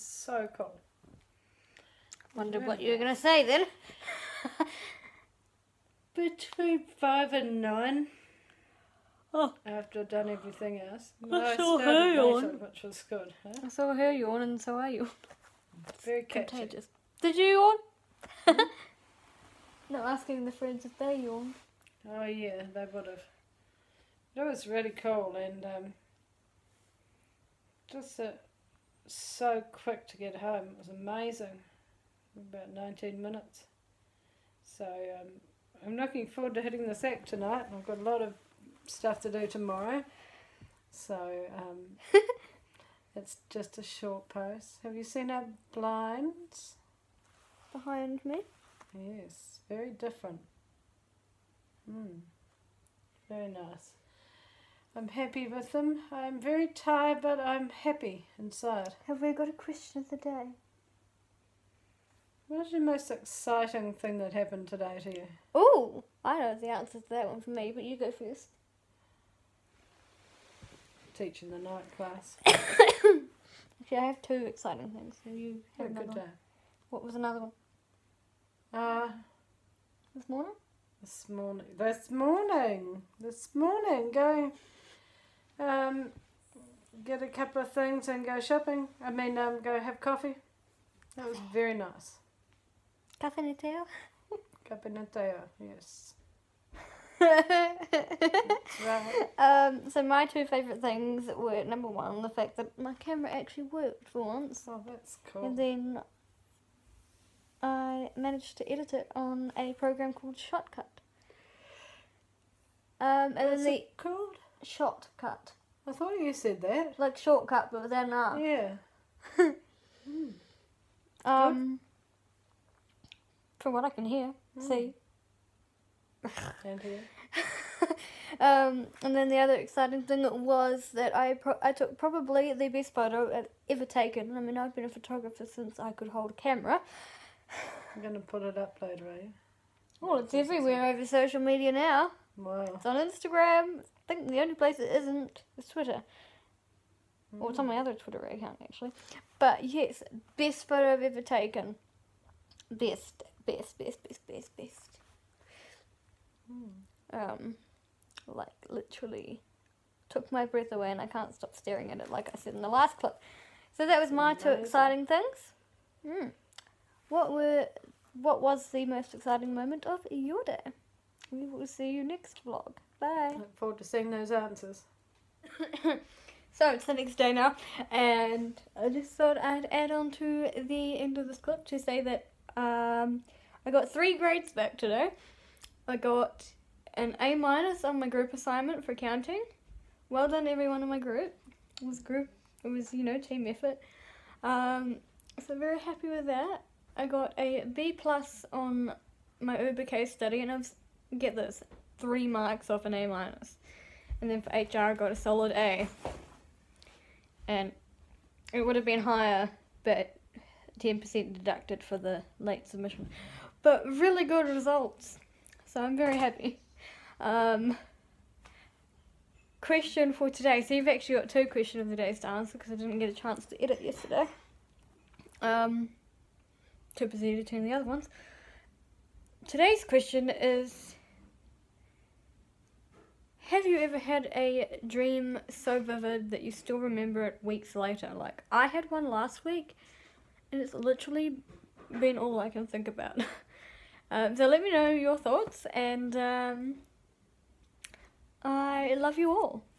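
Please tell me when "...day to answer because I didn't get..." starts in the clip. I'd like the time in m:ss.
3:41.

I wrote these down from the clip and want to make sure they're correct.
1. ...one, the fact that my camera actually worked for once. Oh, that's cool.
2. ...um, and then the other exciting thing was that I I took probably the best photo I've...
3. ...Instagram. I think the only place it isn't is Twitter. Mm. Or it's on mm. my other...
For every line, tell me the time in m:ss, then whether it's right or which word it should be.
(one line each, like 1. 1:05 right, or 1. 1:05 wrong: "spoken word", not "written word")
1. 1:41 right
2. 2:08 right
3. 2:22 right.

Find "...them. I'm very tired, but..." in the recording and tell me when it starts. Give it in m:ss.
0:55.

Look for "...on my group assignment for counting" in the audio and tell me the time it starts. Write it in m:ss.
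3:07.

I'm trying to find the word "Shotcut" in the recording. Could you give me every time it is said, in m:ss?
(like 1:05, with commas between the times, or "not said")
1:50, 1:54.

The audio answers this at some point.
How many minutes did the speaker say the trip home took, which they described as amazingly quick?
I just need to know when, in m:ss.
0:32.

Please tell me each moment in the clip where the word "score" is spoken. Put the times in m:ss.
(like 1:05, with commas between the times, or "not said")
not said.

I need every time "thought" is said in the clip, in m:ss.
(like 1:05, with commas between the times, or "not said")
1:55, 2:59, 4:05.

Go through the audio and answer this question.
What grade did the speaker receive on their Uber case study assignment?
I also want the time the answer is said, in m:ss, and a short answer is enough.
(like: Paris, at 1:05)
B plus, at 3:17.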